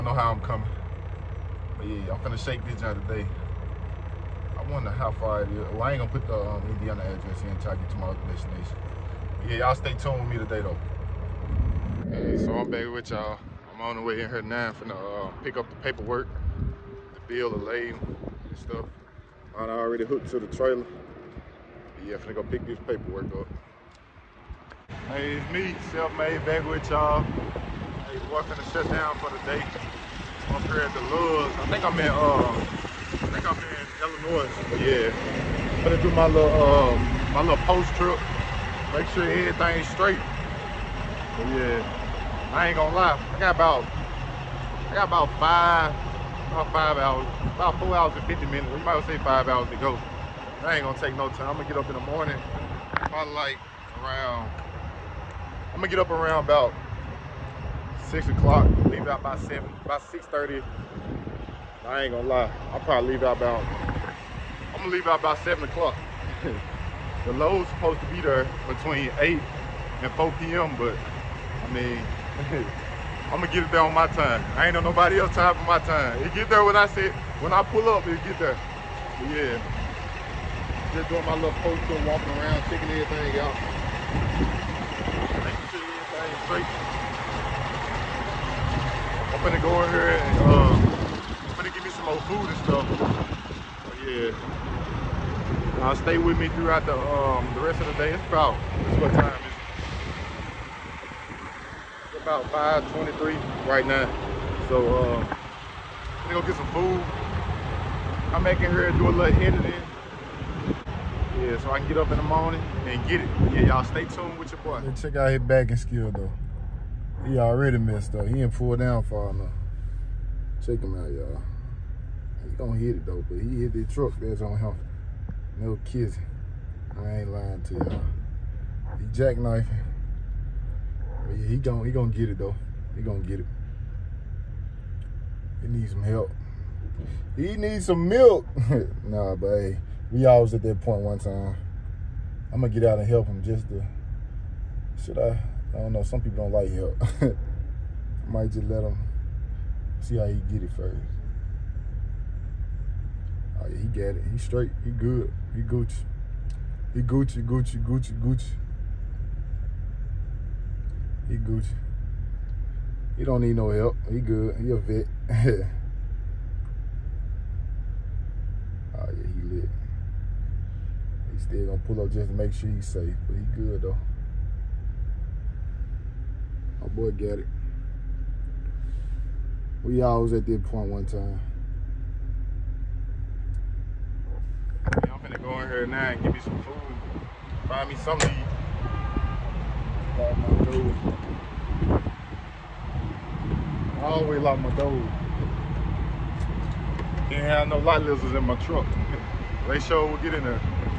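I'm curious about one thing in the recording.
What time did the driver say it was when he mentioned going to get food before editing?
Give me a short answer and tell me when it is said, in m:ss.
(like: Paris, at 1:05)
5:23, at 1:42.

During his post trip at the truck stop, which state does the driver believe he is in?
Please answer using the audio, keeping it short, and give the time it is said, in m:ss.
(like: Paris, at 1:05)
Illinois, at 0:34.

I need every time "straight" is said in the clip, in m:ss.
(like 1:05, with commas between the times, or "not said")
0:39, 1:26, 2:34.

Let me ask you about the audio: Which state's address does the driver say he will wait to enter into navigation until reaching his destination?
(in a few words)
Indiana.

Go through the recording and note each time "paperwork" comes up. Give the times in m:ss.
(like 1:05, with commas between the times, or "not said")
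0:15, 0:22.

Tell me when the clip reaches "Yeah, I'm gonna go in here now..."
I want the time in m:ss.
3:04.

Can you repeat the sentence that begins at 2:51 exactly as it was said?
He still gonna pull up just to make sure he's safe, but he good though.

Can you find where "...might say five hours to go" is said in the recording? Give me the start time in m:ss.
0:48.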